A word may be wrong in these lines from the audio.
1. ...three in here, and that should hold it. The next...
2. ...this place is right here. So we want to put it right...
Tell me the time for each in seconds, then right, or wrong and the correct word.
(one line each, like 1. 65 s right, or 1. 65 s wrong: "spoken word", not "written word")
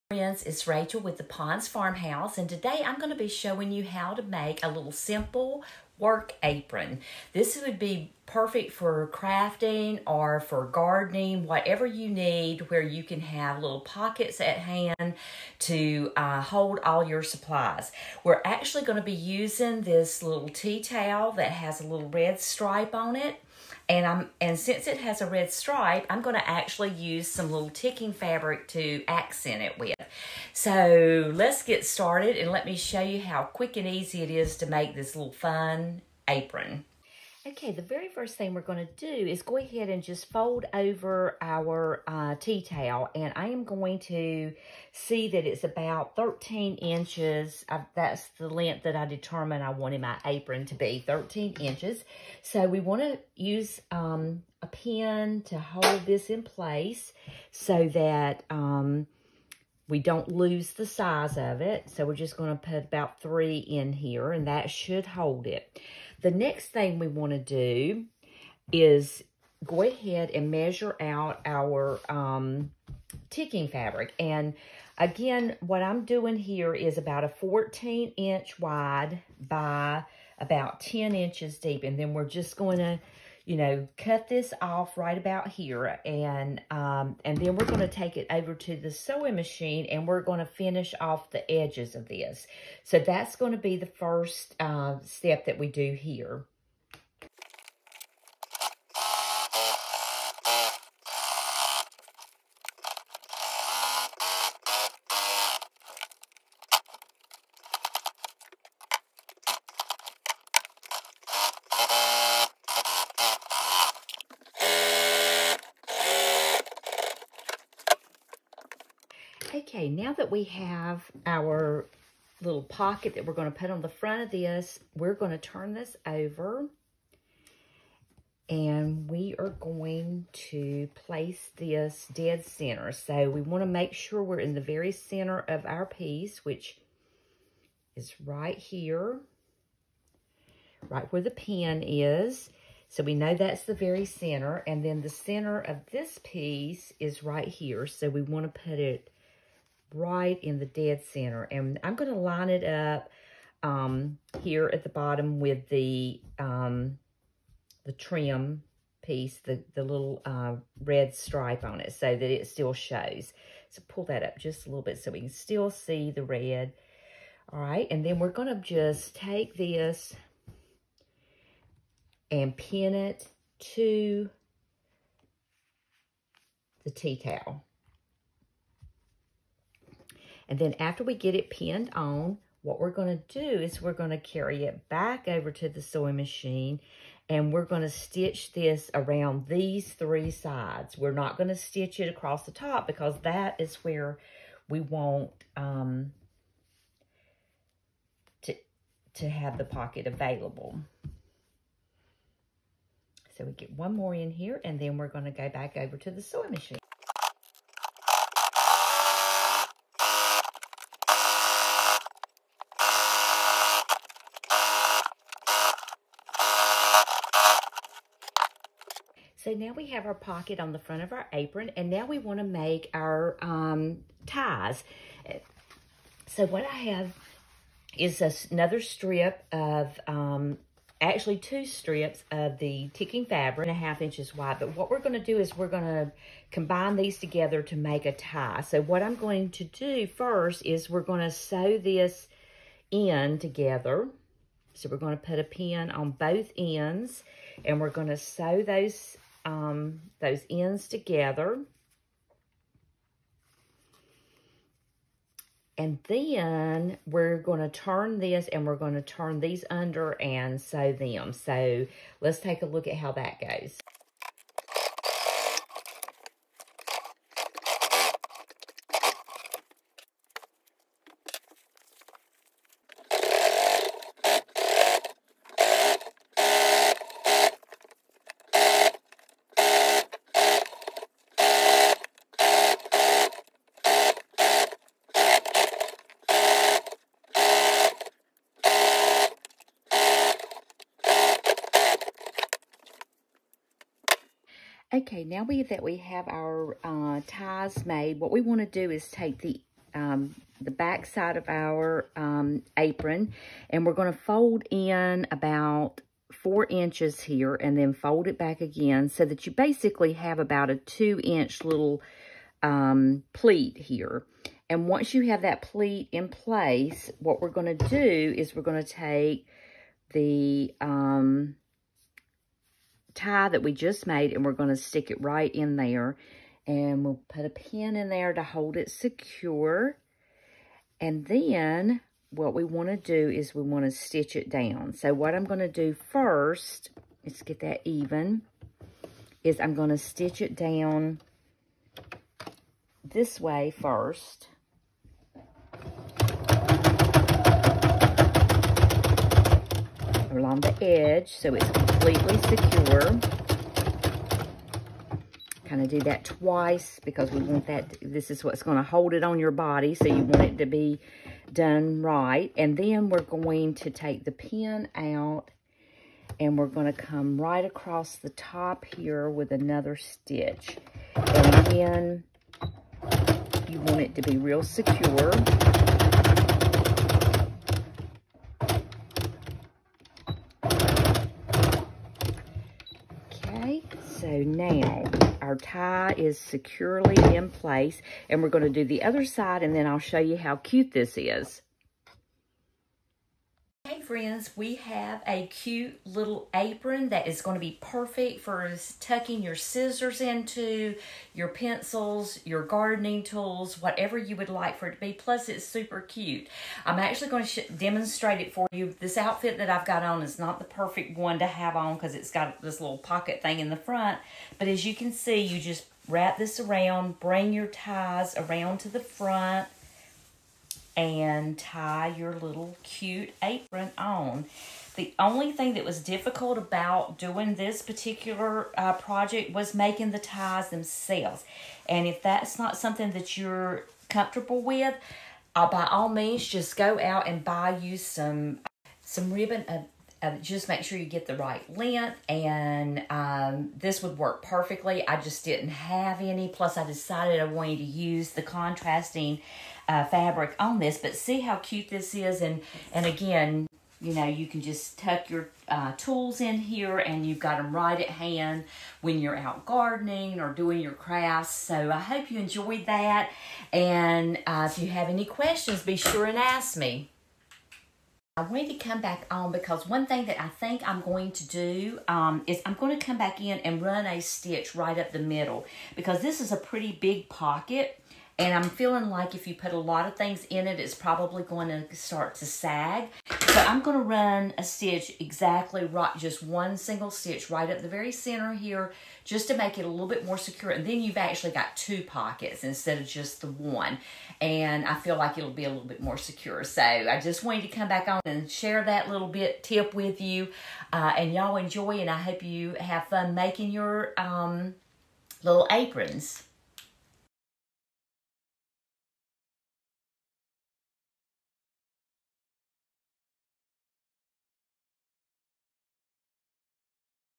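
1. 63 s right
2. 145 s wrong: "piece", not "place".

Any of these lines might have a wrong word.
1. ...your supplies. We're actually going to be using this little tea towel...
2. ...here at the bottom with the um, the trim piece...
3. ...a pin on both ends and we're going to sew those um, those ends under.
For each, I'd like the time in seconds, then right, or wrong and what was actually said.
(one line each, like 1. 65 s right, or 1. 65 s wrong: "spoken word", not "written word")
1. 17 s right
2. 154 s right
3. 245 s wrong: "together", not "under".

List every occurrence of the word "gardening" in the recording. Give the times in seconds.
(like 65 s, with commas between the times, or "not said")
10 s, 402 s, 459 s.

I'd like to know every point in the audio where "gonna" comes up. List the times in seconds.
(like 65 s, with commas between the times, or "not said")
26 s, 168 s.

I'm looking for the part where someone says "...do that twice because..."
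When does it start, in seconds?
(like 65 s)
355 s.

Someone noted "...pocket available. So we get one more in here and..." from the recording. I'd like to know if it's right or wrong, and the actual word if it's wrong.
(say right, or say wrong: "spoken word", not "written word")
right.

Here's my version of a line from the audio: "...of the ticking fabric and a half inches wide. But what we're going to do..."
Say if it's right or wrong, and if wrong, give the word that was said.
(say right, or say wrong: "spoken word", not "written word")
right.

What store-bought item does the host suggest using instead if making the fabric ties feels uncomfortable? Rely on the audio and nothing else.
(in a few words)
ribbon.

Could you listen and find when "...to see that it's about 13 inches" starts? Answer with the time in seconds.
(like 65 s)
44 s.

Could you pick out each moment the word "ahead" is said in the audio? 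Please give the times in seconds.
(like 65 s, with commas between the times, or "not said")
39 s, 69 s.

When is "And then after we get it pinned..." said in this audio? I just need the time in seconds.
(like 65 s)
180 s.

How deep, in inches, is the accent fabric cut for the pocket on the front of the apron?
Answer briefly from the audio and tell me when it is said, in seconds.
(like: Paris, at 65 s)
10 inches, at 80 s.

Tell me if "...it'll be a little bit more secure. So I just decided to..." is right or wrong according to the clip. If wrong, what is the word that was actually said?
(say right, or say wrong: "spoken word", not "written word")
wrong: "wanted", not "decided".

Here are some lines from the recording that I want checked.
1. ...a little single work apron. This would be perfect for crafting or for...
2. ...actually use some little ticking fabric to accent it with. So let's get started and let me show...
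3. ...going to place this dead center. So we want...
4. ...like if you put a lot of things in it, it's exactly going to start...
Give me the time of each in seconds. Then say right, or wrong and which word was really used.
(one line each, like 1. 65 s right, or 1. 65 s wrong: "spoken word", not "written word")
1. 4 s wrong: "simple", not "single"
2. 26 s right
3. 129 s right
4. 479 s wrong: "probably", not "exactly".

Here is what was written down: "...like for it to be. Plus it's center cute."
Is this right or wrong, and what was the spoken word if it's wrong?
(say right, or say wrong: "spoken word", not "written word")
wrong: "super", not "center".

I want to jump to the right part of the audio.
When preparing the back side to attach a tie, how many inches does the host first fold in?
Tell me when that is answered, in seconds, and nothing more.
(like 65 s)
306 s.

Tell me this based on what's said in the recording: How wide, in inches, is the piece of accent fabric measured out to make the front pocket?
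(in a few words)
14 inches.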